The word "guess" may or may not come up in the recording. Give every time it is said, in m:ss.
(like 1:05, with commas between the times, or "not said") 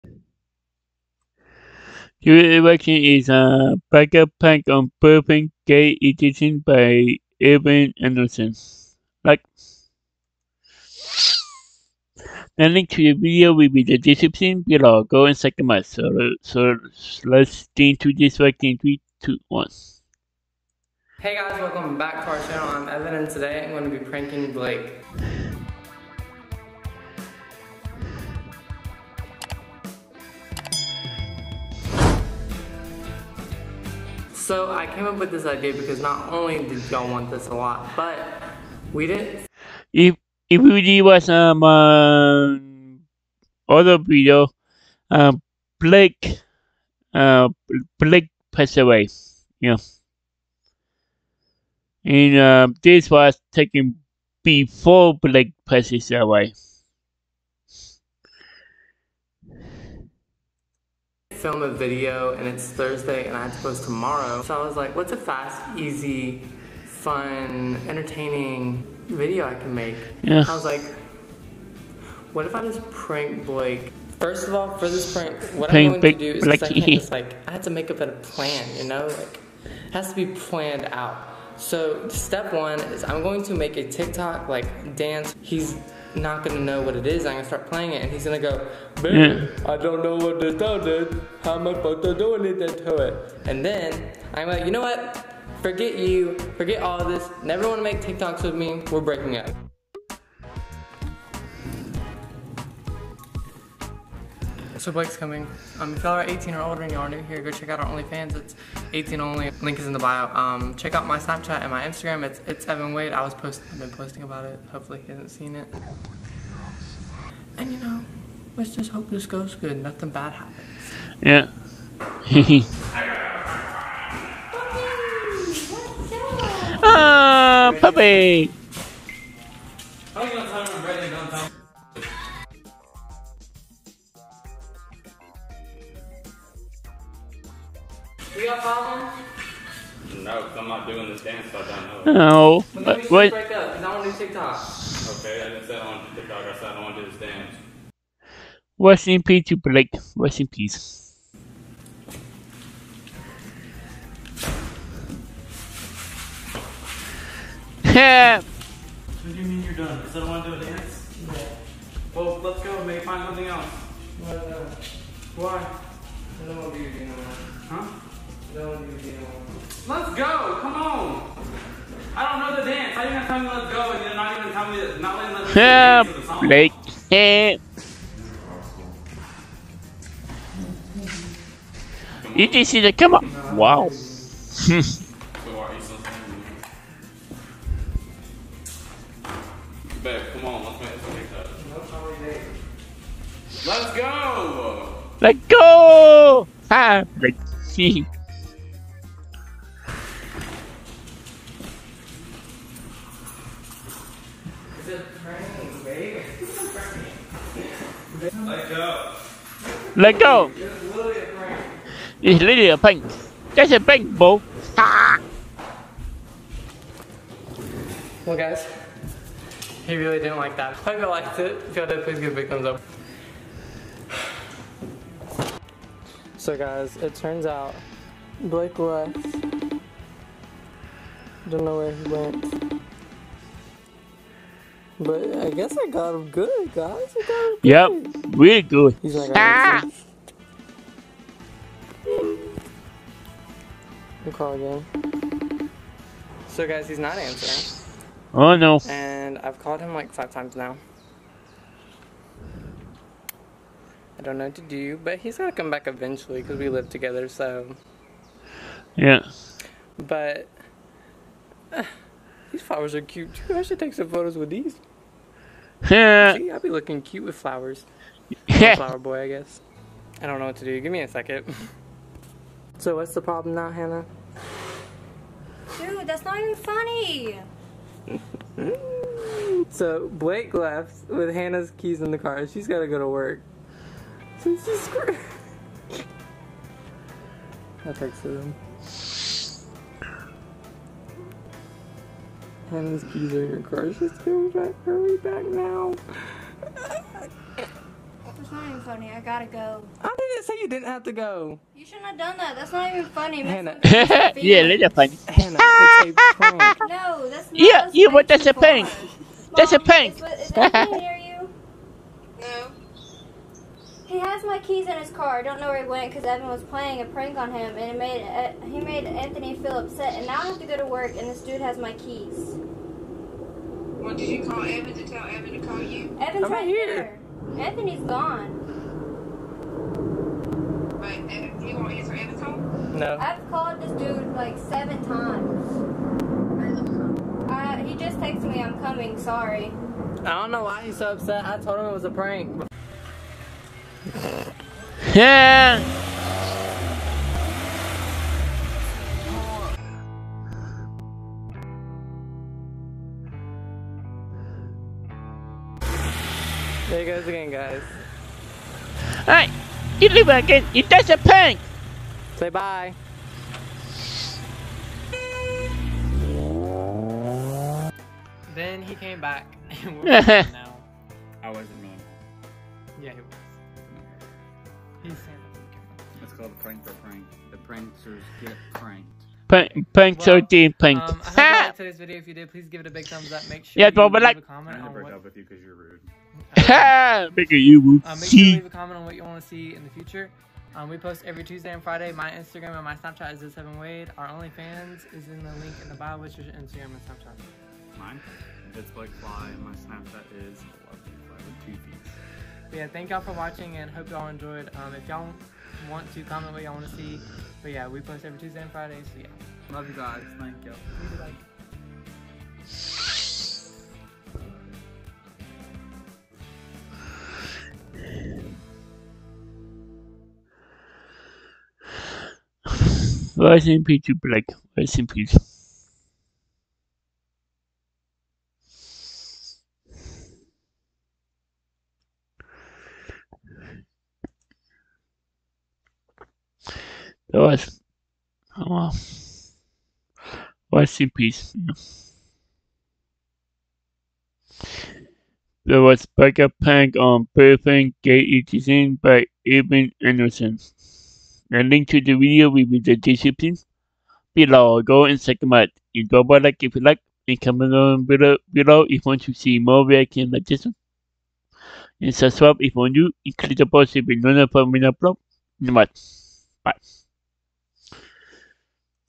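3:55, 4:29.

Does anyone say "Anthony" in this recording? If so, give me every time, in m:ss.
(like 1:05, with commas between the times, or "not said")
5:19, 5:27.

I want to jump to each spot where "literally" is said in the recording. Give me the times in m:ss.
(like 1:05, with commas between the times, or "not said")
3:32.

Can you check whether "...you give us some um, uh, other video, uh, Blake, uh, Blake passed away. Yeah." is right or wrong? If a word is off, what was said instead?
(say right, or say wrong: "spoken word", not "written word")
right.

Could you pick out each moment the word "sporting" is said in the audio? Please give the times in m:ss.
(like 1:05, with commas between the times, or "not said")
not said.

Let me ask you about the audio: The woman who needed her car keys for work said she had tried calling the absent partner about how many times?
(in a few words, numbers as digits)
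7.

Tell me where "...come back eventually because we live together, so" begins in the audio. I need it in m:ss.
4:15.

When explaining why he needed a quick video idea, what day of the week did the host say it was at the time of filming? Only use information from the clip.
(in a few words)
Thursday.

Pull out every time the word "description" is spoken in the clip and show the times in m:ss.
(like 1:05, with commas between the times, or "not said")
0:13, 7:32.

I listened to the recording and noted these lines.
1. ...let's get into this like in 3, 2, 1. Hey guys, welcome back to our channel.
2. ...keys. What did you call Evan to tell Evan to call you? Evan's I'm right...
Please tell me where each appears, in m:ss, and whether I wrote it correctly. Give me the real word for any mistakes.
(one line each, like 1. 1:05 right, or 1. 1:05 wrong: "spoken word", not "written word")
1. 0:17 right
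2. 5:21 right.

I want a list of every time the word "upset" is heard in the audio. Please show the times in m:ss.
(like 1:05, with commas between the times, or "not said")
5:19, 5:41.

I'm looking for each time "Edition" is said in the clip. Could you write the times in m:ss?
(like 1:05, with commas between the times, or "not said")
0:06, 7:28.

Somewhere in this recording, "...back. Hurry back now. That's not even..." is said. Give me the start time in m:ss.
4:54.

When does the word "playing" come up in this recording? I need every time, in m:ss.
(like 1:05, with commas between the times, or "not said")
1:27, 5:16.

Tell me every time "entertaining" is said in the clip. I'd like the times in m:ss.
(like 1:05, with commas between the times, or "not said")
1:07.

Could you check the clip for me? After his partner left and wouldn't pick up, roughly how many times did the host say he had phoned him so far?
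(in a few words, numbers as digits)
5.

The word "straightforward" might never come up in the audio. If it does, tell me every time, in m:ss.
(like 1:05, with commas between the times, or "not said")
not said.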